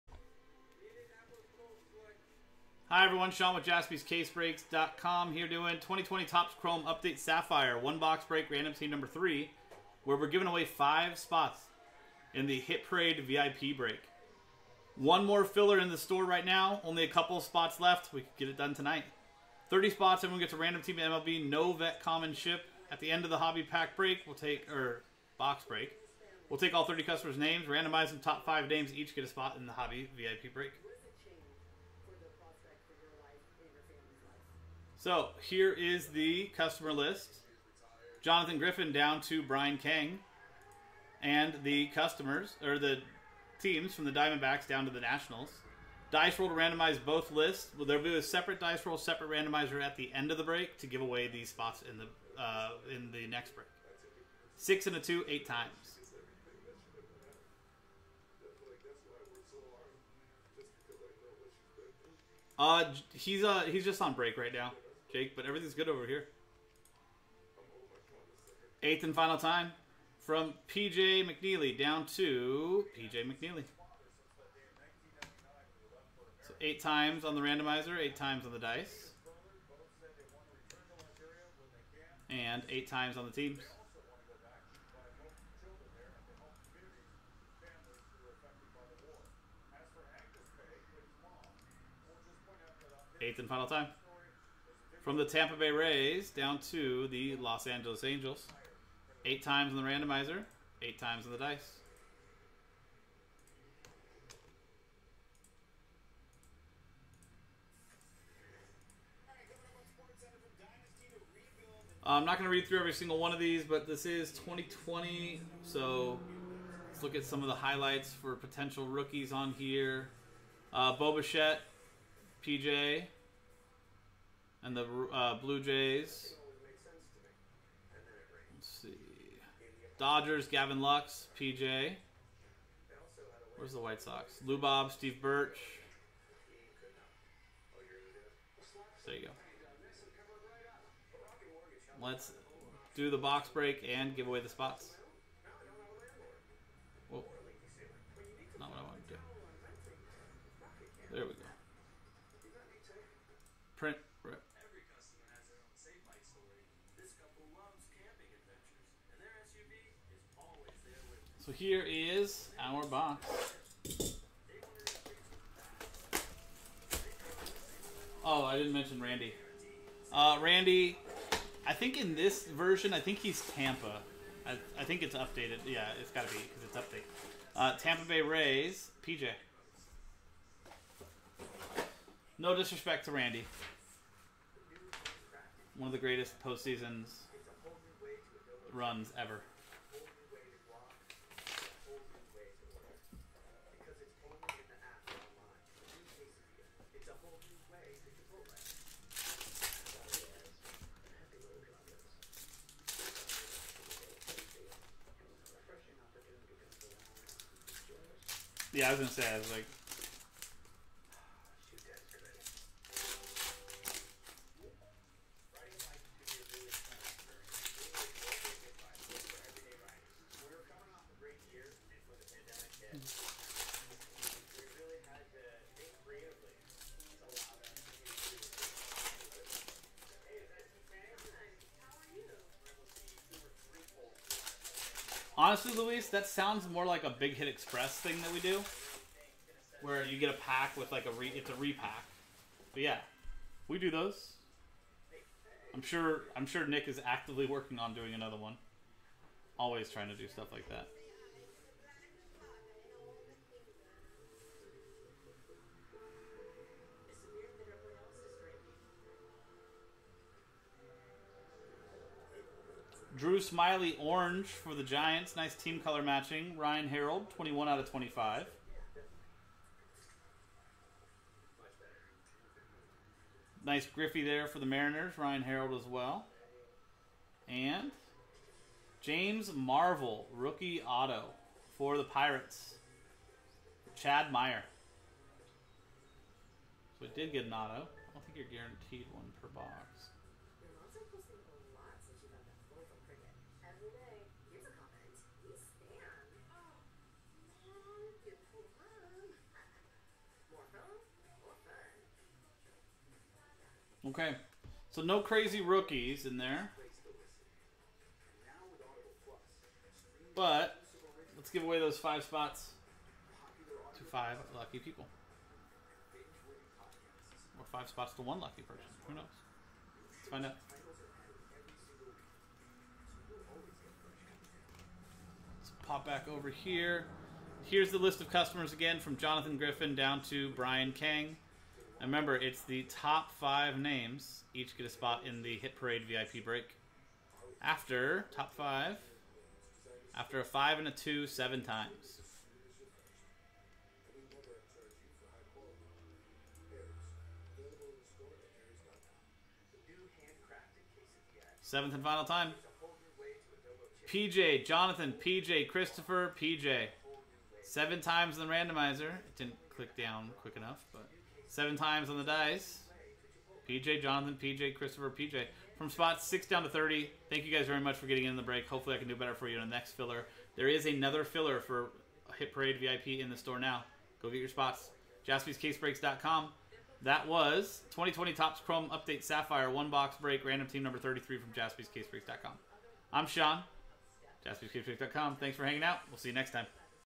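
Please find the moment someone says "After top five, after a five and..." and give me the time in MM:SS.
05:37.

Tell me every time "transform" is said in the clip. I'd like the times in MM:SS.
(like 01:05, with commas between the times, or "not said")
not said.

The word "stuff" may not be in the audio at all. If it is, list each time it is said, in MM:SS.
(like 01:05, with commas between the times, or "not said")
04:10.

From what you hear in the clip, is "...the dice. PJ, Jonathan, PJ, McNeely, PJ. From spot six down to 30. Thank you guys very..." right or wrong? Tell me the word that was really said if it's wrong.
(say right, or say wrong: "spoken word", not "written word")
wrong: "Christopher", not "McNeely".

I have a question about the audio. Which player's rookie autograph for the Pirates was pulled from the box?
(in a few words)
James Marvel.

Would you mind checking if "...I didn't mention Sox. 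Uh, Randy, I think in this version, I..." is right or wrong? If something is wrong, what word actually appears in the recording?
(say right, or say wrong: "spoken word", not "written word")
wrong: "Randy", not "Sox".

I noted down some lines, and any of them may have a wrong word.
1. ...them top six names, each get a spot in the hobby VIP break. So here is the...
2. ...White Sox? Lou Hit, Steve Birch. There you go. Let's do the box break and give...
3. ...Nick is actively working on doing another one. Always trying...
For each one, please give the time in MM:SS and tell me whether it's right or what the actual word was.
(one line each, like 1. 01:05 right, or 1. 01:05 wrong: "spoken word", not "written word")
1. 00:28 wrong: "five", not "six"
2. 02:13 wrong: "Bob", not "Hit"
3. 04:06 right.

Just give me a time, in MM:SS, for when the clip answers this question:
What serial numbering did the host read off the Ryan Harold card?
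04:27.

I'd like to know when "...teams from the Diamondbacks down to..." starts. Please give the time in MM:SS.
00:43.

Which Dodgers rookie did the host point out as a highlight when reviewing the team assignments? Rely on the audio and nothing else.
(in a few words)
Gavin Lux.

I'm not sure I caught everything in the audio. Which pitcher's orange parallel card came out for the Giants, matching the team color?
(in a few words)
Drew Smyly.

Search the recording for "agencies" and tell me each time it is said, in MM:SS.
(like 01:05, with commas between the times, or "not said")
not said.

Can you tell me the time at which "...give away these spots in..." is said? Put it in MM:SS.
00:50.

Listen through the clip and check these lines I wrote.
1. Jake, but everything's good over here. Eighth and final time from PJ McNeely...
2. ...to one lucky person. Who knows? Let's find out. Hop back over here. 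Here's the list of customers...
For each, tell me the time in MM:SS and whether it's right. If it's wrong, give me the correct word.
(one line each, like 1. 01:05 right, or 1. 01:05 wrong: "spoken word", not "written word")
1. 01:05 right
2. 05:18 right.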